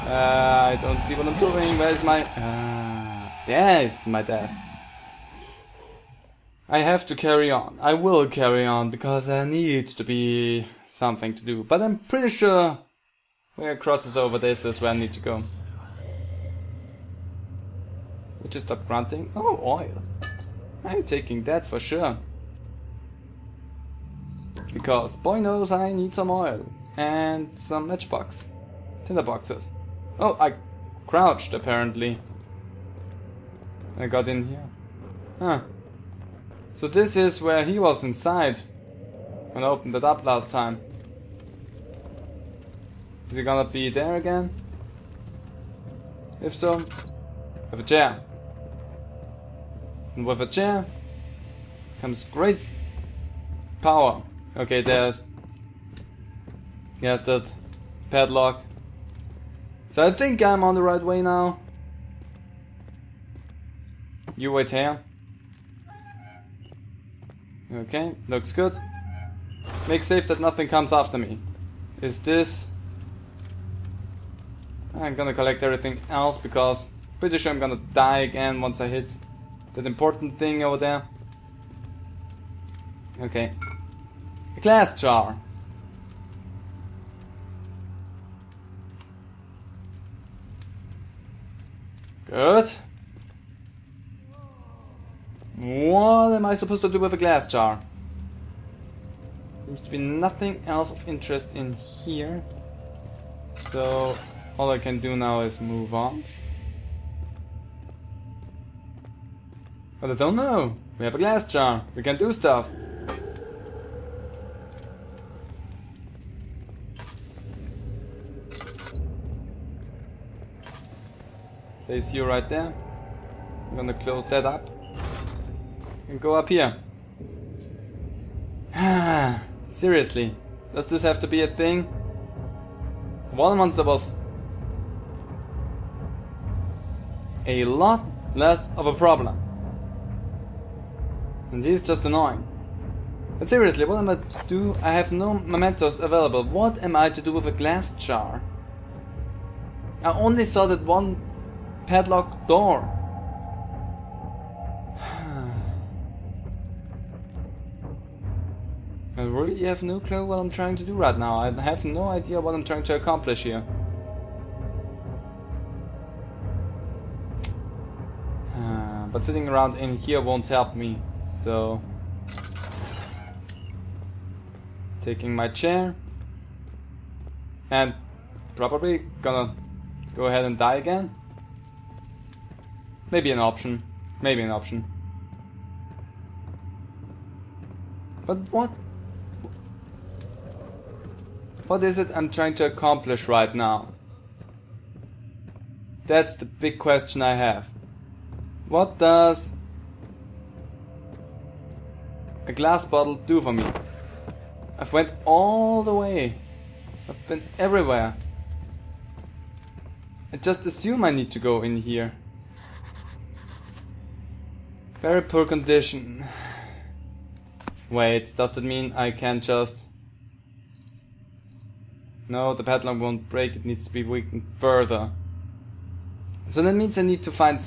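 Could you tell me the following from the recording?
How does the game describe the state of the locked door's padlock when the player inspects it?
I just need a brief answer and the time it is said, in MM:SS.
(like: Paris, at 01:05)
Very poor condition, at 03:34.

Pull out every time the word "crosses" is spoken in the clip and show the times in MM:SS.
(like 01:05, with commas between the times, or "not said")
00:13.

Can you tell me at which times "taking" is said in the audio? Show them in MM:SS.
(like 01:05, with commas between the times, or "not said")
00:21, 02:55.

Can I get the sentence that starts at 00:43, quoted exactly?
Is he gonna be there again?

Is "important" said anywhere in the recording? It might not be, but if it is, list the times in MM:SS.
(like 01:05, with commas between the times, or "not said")
01:19.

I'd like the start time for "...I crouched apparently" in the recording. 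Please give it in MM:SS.
00:30.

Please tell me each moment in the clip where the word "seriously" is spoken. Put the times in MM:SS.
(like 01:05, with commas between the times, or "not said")
02:09, 02:23.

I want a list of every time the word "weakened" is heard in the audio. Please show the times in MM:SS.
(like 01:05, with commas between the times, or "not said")
03:44.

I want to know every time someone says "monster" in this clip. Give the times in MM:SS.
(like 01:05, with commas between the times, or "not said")
02:13.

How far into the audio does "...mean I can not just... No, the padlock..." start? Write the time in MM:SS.
03:38.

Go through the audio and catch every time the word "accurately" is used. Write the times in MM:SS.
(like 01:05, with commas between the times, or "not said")
not said.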